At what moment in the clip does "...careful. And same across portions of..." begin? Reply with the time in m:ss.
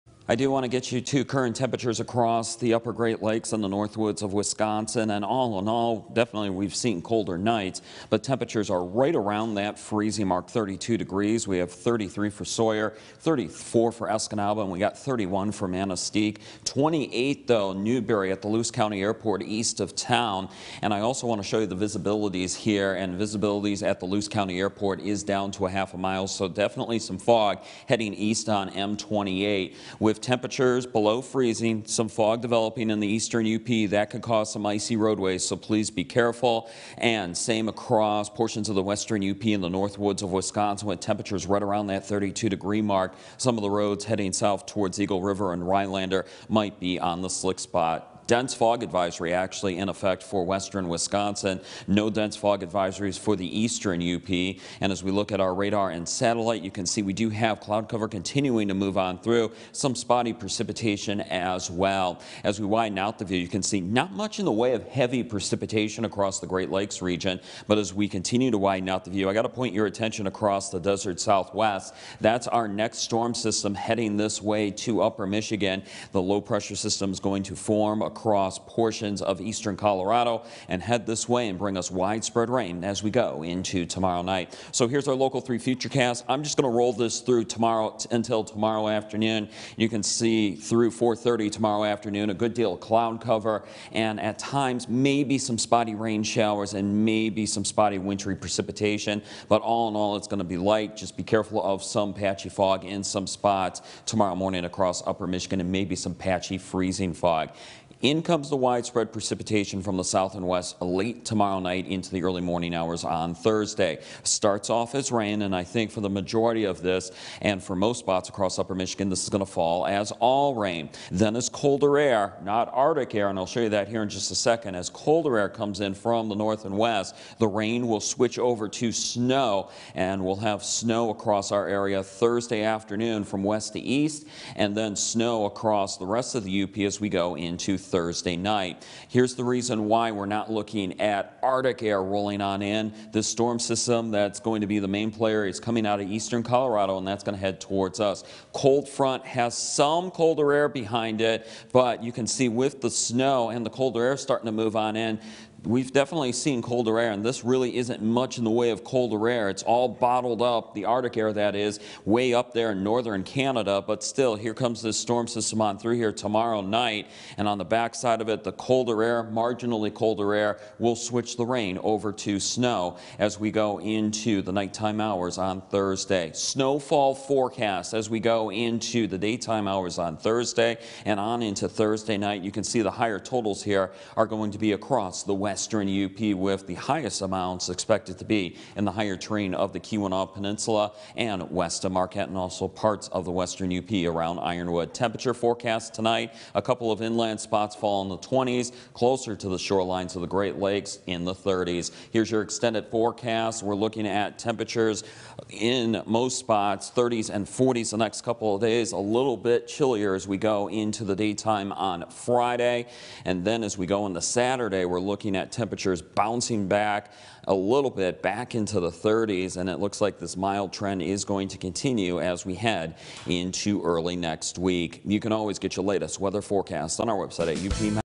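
0:36.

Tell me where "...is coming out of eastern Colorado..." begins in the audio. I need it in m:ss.
2:25.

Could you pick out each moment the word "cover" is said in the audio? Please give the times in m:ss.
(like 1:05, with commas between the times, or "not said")
0:57, 1:33.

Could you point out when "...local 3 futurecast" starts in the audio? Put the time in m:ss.
1:25.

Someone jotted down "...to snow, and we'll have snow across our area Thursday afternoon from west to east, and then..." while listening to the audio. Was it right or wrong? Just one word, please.
right.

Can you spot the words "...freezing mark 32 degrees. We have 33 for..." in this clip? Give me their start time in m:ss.
0:09.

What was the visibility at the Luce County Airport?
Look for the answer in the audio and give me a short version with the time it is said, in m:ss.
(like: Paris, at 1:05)
half a mile, at 0:25.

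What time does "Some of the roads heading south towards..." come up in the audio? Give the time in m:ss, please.
0:43.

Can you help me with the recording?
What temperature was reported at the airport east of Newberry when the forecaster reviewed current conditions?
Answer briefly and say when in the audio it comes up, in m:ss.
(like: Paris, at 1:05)
28, at 0:16.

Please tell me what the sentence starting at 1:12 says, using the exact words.
That's our next storm system heading this way to upper Michigan.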